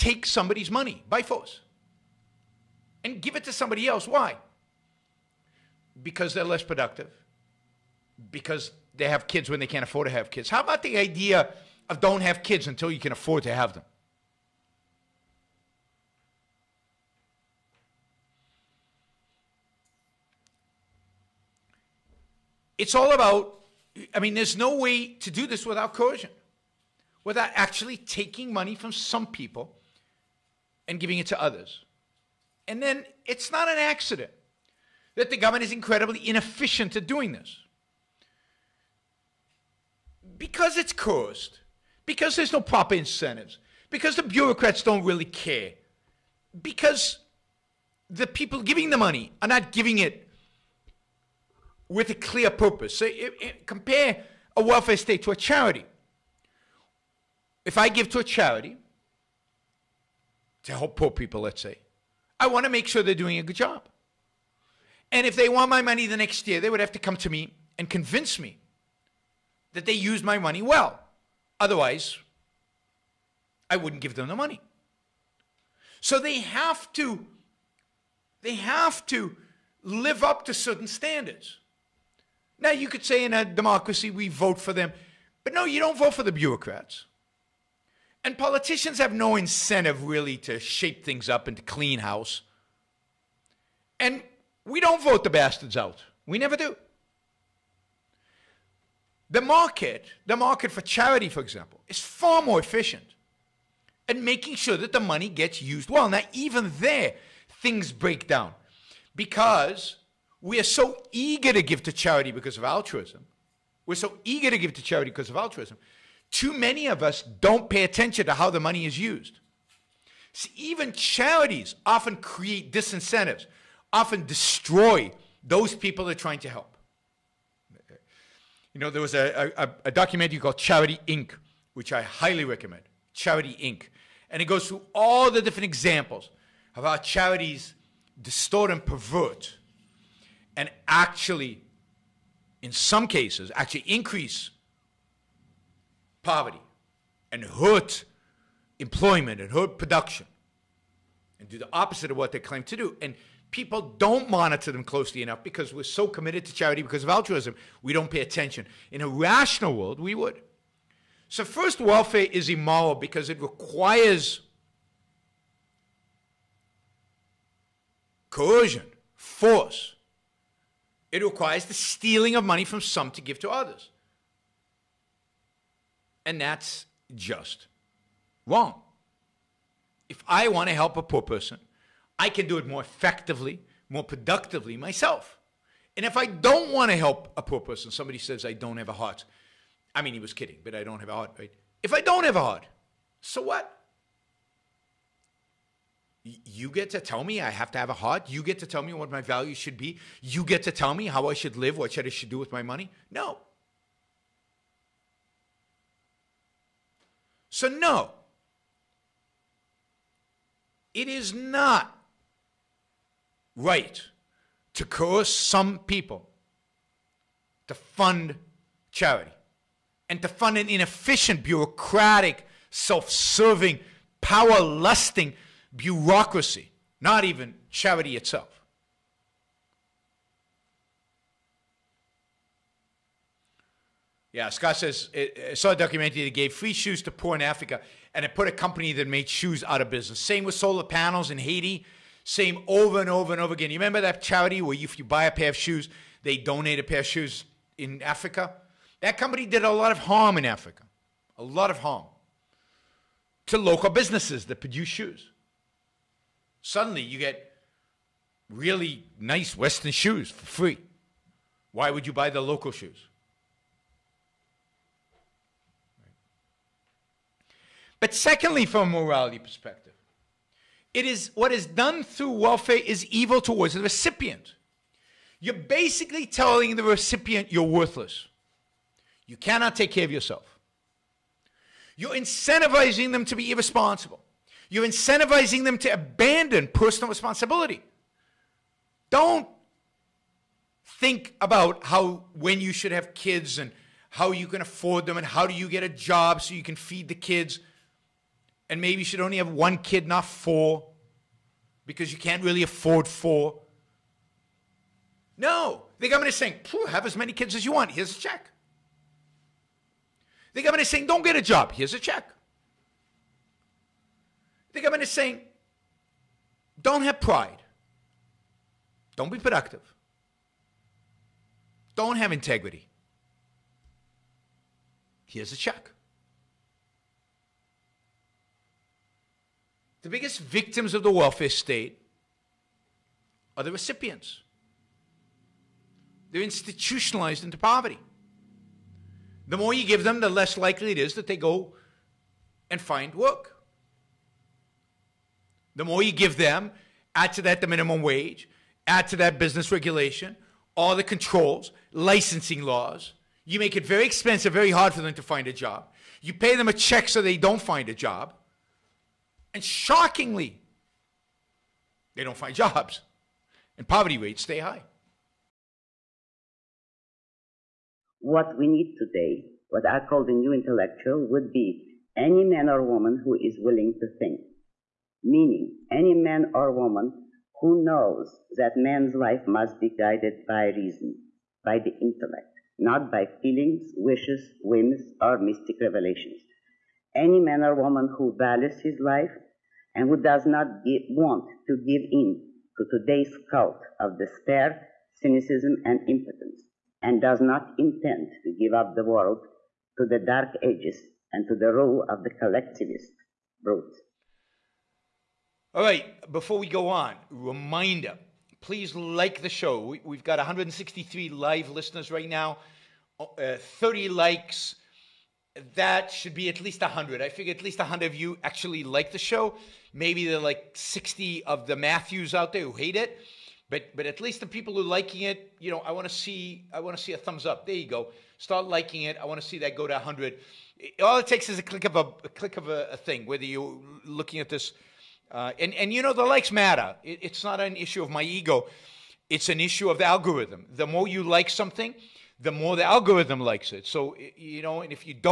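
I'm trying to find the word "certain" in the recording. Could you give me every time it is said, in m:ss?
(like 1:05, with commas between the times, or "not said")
1:20.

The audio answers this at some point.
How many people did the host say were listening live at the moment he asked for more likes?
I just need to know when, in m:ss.
6:50.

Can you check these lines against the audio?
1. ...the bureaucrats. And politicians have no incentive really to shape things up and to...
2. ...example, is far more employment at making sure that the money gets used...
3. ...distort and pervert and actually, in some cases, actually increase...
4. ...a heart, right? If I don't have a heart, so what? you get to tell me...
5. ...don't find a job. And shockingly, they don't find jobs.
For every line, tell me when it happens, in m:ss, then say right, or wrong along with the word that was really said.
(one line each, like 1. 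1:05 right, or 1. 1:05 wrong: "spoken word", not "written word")
1. 1:26 right
2. 1:41 wrong: "efficient", not "employment"
3. 2:18 right
4. 3:11 right
5. 5:57 right.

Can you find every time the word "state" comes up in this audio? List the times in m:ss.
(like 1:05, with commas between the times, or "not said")
0:54, 5:31.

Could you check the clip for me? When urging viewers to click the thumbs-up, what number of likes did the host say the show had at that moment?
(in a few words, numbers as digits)
30.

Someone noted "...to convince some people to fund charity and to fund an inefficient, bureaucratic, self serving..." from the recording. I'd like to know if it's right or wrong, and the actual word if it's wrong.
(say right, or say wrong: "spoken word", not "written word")
wrong: "coerce", not "convince".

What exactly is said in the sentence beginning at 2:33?
And people don't monitor them closely enough because we're so committed to charity because of altruism.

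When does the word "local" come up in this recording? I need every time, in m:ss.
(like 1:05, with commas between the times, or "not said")
4:13, 4:22.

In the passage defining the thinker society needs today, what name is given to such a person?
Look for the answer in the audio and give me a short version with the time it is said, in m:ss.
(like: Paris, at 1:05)
the new intellectual, at 6:10.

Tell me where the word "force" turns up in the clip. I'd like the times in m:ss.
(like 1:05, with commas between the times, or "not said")
0:01, 2:49.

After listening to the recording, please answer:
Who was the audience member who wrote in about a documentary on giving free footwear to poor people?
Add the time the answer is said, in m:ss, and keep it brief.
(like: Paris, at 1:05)
Scott, at 3:54.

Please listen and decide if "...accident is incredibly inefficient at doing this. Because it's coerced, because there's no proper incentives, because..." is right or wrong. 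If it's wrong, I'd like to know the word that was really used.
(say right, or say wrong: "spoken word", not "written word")
wrong: "government", not "accident".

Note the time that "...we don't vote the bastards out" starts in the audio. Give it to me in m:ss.
1:34.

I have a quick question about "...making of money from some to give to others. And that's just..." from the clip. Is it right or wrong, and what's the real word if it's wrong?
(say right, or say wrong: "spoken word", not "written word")
wrong: "stealing", not "making".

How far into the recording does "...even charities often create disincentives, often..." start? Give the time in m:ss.
2:00.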